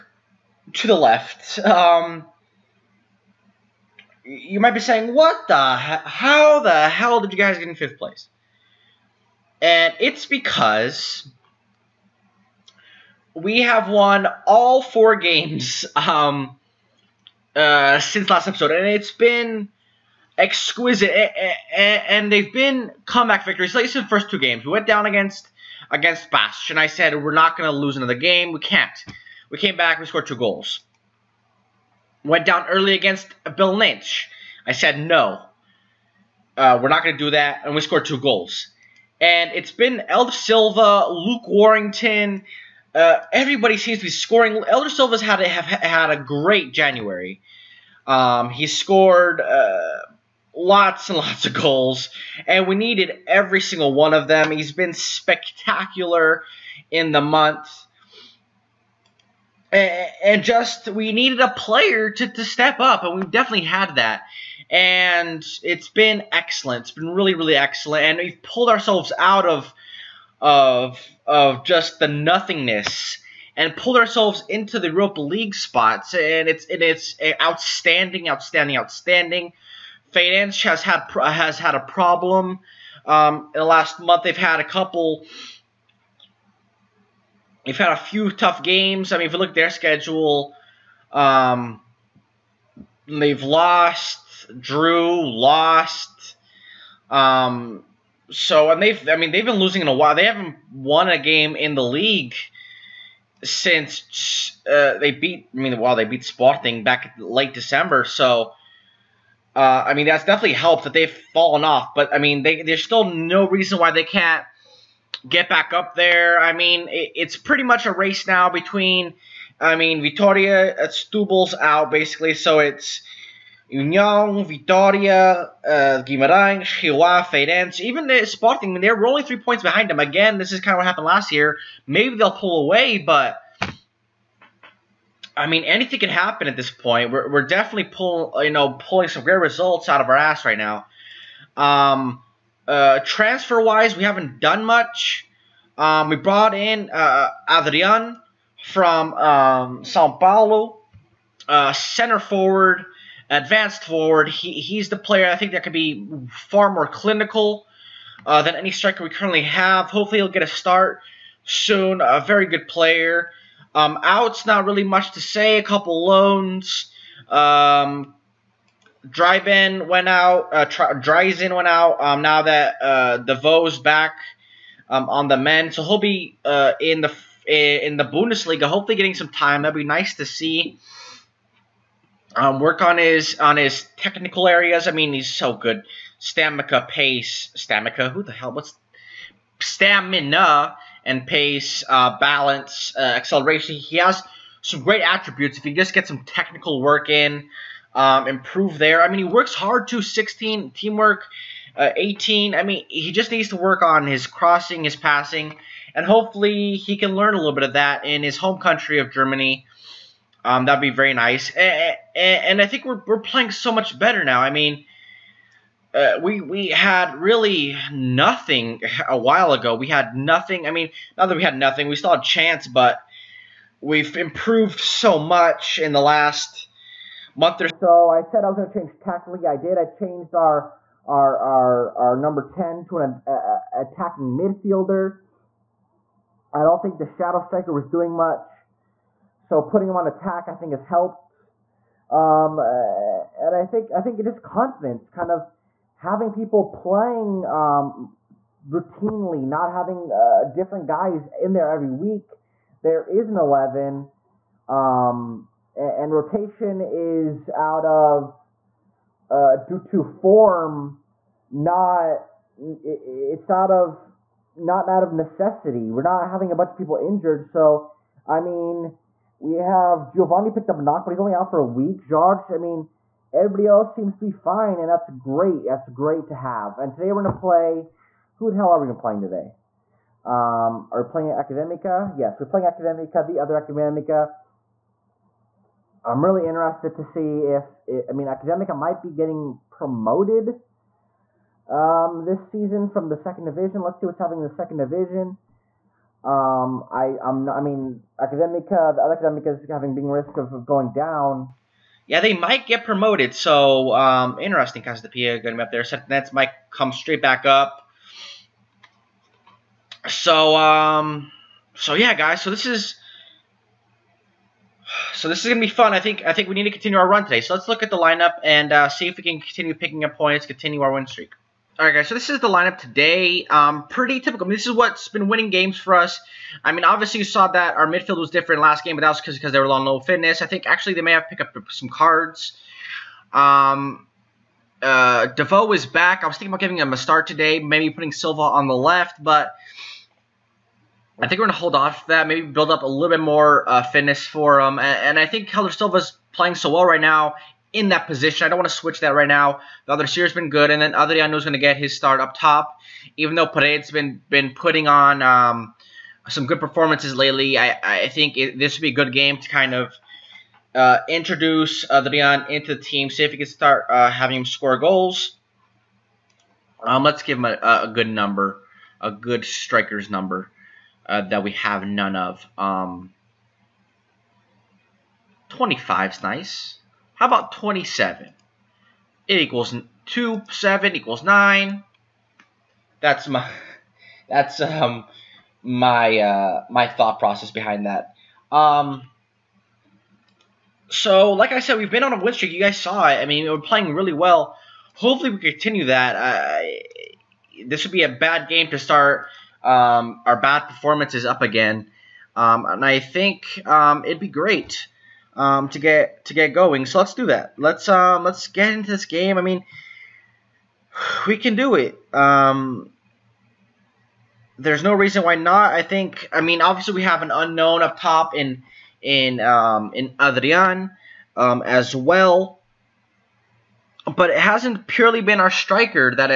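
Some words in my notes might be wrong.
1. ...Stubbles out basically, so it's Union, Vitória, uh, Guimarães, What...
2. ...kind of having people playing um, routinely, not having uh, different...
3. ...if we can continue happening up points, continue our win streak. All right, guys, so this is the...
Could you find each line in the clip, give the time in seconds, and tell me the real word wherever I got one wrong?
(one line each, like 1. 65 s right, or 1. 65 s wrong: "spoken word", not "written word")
1. 120 s wrong: "Chihuahua", not "What"
2. 245 s right
3. 319 s wrong: "picking", not "happening".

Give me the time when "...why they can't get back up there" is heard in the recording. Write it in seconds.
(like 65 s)
113 s.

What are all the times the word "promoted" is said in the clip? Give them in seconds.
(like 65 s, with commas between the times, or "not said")
289 s, 302 s.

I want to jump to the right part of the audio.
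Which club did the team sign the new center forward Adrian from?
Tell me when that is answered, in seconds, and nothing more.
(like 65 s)
149 s.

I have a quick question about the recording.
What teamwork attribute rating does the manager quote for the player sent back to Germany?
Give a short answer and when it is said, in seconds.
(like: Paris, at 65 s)
18, at 201 s.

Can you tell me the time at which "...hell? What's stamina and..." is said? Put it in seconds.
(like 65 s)
188 s.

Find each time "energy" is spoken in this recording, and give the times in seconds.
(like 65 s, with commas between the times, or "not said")
not said.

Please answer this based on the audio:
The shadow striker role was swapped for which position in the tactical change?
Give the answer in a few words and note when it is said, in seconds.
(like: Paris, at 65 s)
attacking midfielder, at 233 s.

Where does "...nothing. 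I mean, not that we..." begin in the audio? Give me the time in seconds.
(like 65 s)
220 s.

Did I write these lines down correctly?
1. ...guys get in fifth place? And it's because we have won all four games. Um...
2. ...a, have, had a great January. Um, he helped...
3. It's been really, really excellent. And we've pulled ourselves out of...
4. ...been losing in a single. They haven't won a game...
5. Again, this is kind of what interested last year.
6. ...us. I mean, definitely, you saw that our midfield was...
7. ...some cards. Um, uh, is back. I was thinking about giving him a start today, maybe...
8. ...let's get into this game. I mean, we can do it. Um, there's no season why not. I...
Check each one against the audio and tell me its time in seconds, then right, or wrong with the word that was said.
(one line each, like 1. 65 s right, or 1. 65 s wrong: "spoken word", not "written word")
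1. 7 s right
2. 45 s wrong: "scored", not "helped"
3. 66 s right
4. 99 s wrong: "while", not "single"
5. 129 s wrong: "happened", not "interested"
6. 325 s wrong: "obviously", not "definitely"
7. 331 s right
8. 408 s wrong: "reason", not "season".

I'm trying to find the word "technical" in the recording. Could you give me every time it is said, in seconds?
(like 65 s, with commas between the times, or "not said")
183 s, 196 s.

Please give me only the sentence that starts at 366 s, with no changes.
Um, let's give him a, a good number, a good striker's number uh, that we have none of.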